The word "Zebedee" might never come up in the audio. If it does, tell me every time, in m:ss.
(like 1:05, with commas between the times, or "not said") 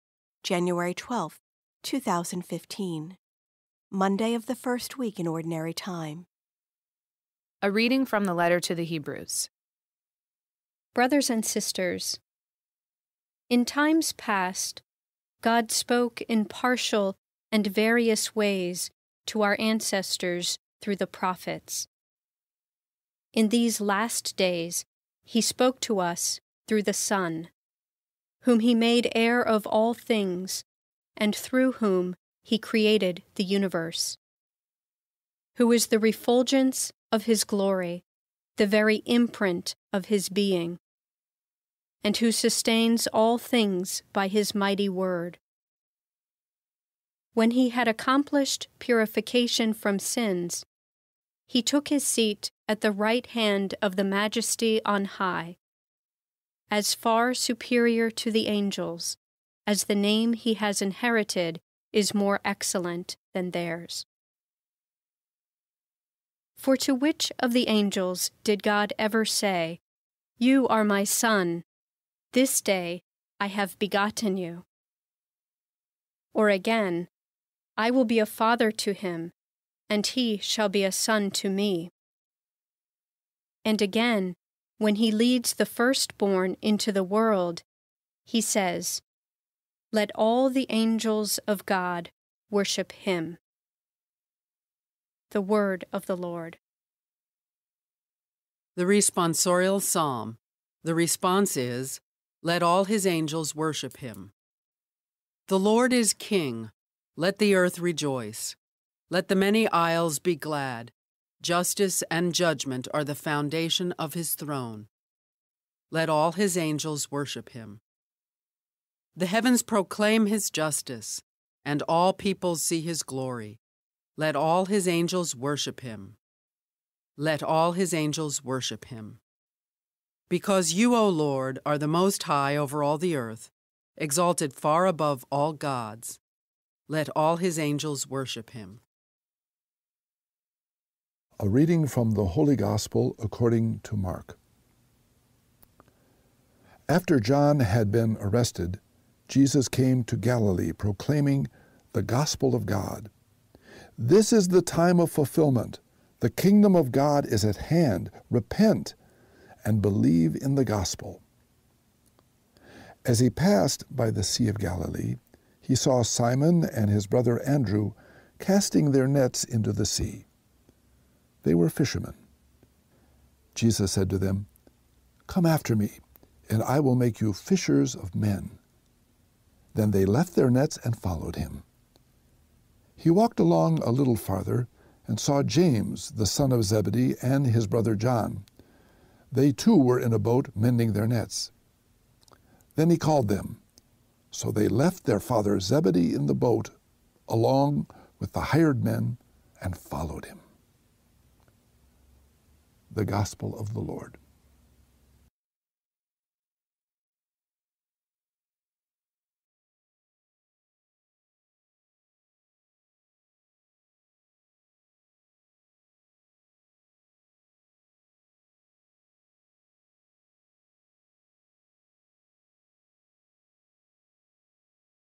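3:06, 3:15.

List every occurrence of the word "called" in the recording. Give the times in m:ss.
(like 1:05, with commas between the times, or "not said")
3:12.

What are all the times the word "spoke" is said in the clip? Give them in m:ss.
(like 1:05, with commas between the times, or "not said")
0:15, 0:25.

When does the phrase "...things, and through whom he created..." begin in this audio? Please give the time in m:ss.
0:29.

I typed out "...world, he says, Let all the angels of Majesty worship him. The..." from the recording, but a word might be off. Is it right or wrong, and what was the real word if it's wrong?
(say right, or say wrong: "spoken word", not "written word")
wrong: "God", not "Majesty".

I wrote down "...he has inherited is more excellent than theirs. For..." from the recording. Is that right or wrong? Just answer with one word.
right.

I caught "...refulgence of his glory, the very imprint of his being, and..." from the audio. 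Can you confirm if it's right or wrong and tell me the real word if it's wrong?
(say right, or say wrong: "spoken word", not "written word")
right.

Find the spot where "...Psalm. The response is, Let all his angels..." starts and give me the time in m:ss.
1:39.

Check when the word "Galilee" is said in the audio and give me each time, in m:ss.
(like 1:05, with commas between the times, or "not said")
2:30, 2:44.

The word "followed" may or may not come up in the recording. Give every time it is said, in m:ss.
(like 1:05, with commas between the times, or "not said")
3:00, 3:19.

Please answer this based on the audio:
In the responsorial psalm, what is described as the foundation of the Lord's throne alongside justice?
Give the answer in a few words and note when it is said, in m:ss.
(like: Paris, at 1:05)
judgment, at 1:52.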